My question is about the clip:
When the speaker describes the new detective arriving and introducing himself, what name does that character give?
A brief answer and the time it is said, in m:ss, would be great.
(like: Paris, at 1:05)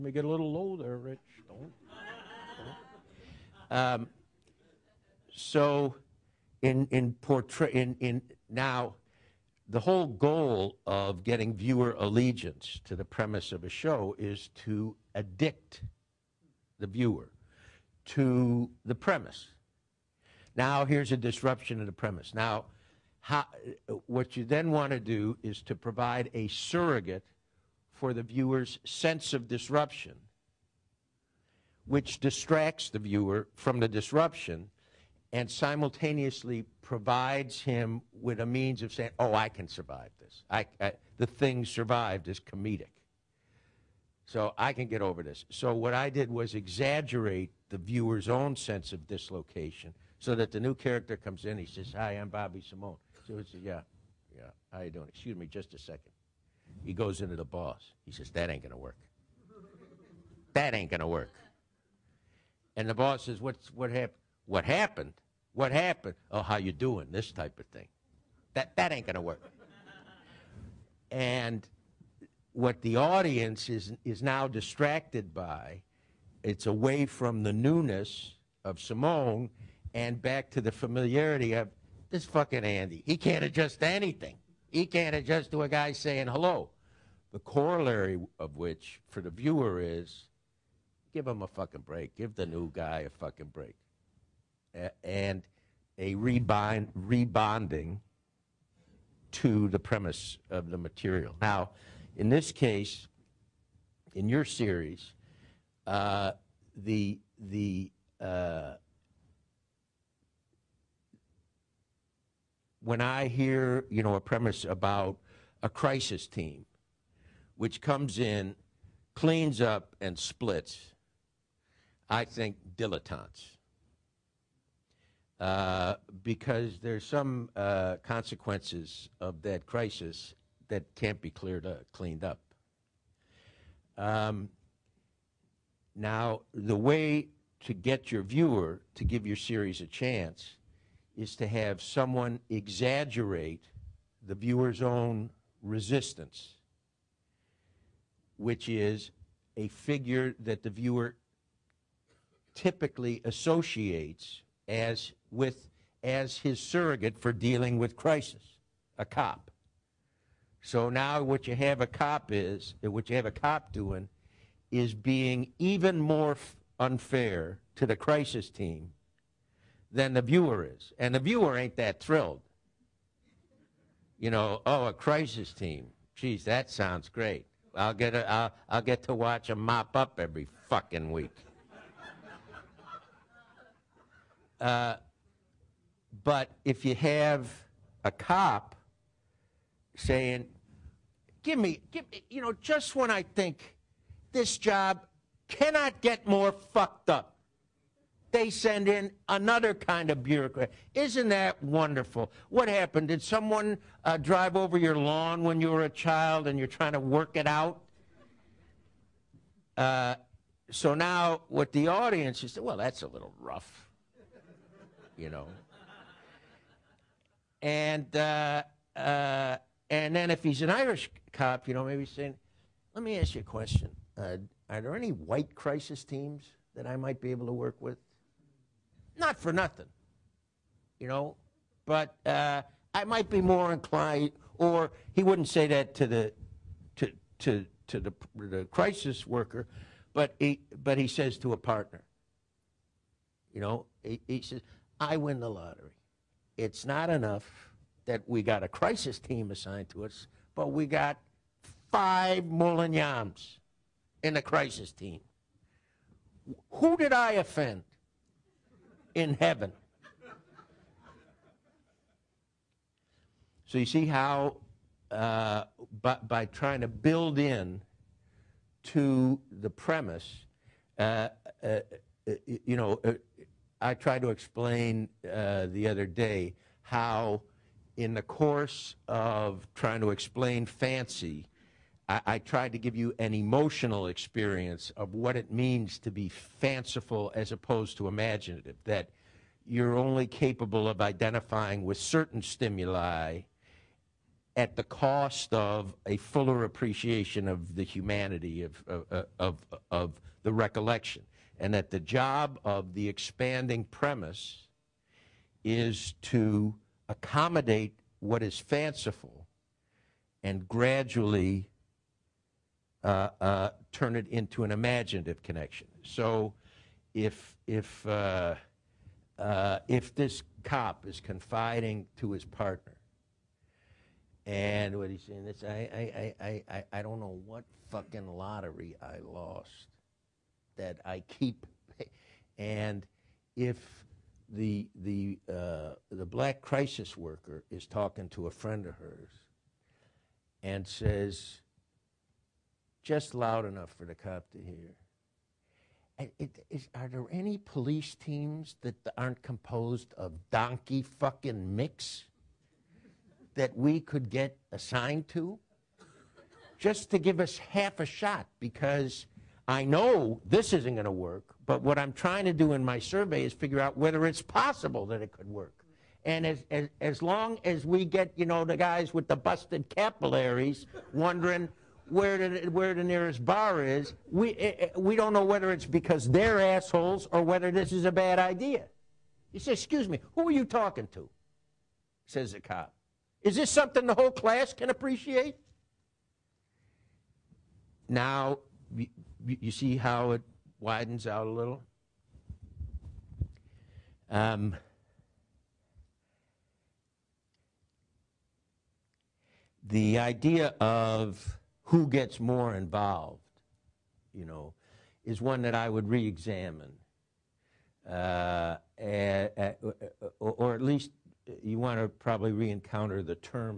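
Bobby Simone, at 0:52.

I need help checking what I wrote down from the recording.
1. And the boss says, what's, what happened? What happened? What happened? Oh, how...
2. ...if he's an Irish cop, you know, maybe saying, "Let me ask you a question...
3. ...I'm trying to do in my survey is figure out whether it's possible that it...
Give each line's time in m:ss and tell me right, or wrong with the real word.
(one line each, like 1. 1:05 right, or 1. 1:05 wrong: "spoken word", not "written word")
1. 1:02 right
2. 3:40 right
3. 6:01 right.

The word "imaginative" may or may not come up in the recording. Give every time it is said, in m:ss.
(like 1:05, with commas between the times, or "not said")
4:48, 5:14.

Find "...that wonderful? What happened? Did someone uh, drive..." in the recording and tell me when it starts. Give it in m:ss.
3:21.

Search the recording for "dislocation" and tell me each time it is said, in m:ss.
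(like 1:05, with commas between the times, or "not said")
0:49.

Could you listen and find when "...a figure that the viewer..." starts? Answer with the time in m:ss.
2:29.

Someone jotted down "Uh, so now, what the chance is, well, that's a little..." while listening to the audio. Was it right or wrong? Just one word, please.
wrong.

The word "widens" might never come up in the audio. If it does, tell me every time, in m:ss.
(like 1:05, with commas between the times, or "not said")
6:30.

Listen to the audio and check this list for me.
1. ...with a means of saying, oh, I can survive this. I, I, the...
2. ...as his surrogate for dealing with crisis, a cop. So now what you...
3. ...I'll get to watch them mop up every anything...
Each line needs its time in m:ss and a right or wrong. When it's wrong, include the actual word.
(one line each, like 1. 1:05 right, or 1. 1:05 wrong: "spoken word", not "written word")
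1. 0:38 right
2. 2:36 right
3. 2:58 wrong: "fucking", not "anything".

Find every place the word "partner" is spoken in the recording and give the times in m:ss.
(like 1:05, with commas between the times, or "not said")
4:01, 5:22.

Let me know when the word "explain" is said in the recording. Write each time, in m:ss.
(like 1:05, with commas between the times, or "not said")
4:34, 4:40.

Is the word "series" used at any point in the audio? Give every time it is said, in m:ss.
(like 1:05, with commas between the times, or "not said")
1:44, 2:19.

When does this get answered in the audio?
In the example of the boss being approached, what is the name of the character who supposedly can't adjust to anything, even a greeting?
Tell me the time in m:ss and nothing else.
1:22.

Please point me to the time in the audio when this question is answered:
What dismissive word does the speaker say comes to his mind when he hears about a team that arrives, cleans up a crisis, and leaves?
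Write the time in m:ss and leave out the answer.
2:02.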